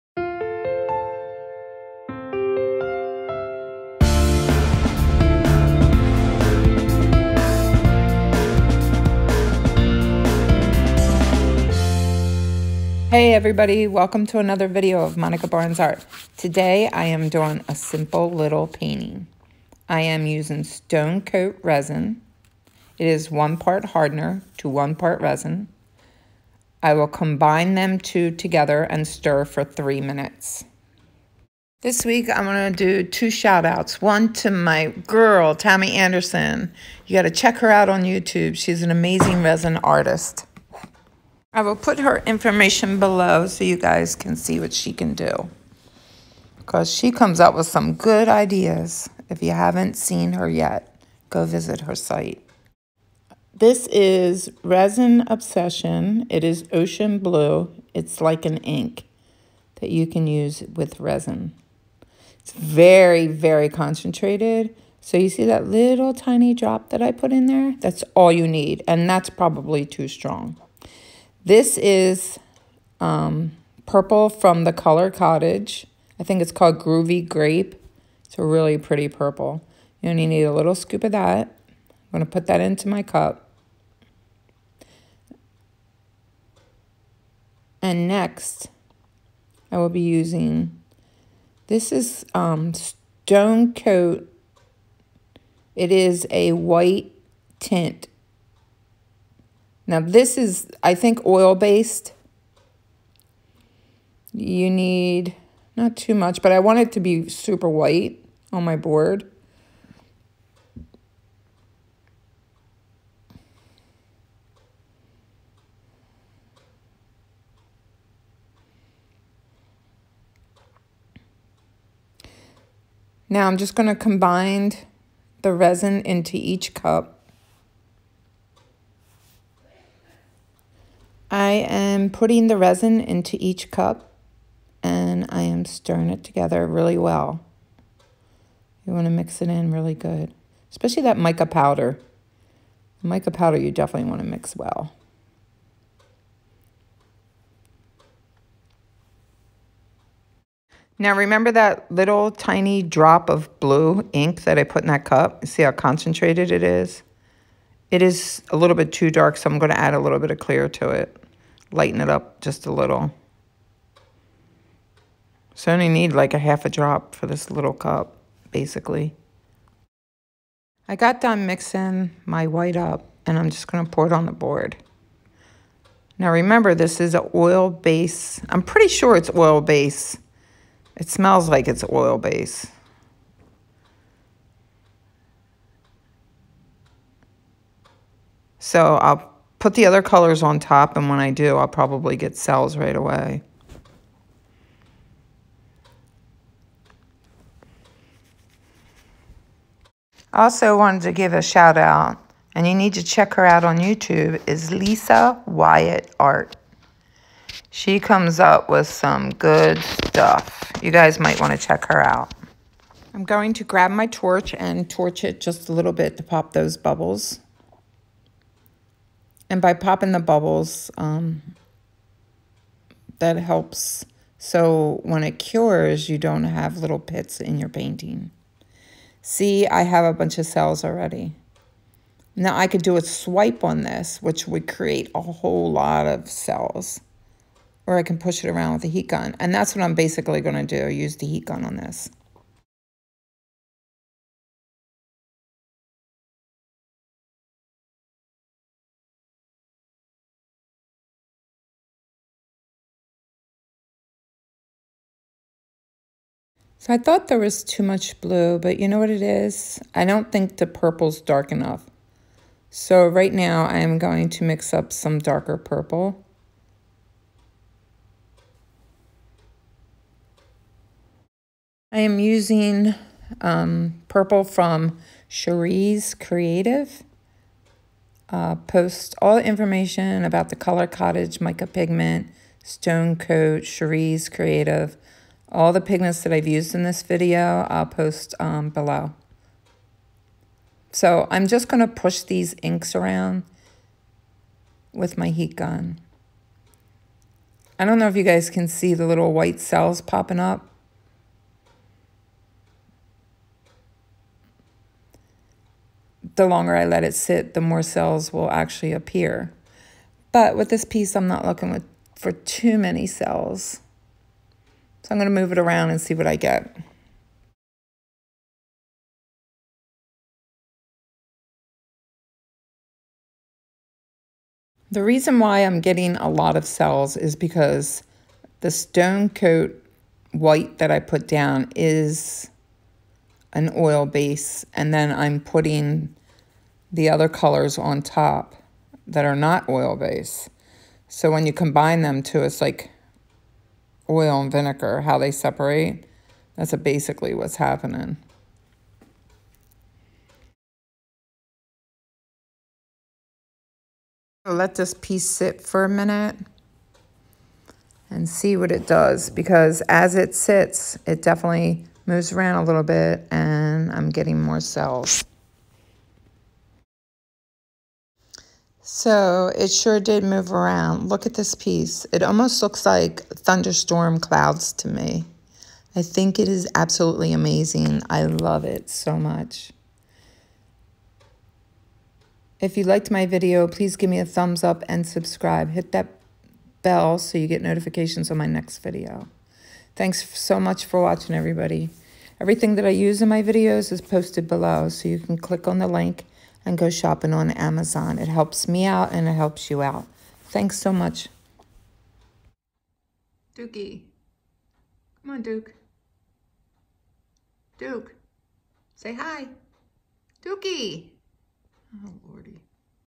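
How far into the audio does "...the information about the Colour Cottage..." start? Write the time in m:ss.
4:39.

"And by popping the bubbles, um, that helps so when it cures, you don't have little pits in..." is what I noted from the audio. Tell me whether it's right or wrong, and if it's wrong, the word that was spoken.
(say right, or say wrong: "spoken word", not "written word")
right.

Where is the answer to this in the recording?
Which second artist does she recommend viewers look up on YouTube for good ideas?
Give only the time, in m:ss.
3:24.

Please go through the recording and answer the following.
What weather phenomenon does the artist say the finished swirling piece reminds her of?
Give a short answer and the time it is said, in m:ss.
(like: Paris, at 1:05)
thunderstorm clouds, at 6:13.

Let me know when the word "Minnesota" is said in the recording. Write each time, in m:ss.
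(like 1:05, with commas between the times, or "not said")
not said.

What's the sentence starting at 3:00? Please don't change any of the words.
It smells like it's oil base.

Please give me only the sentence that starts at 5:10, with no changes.
But with this piece, I'm not looking with, for too many cells.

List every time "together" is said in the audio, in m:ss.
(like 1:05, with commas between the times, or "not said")
0:28, 2:16.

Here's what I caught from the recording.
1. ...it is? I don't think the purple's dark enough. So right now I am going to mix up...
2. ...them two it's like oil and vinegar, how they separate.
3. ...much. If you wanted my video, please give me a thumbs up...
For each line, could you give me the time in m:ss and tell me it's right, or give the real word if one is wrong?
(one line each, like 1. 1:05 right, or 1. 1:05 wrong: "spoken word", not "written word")
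1. 4:19 right
2. 5:42 right
3. 6:19 wrong: "liked", not "wanted".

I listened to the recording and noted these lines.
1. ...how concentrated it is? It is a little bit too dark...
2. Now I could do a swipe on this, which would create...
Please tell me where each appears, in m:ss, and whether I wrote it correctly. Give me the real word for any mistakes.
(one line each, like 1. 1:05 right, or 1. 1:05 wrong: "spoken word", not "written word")
1. 2:35 right
2. 3:52 right.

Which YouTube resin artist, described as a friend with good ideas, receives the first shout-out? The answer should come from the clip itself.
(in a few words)
Tammy Anderson.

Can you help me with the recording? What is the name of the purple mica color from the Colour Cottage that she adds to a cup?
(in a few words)
Groovy Grape.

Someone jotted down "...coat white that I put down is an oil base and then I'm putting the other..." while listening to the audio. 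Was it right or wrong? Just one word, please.
right.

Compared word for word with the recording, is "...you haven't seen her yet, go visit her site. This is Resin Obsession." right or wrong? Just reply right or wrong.
right.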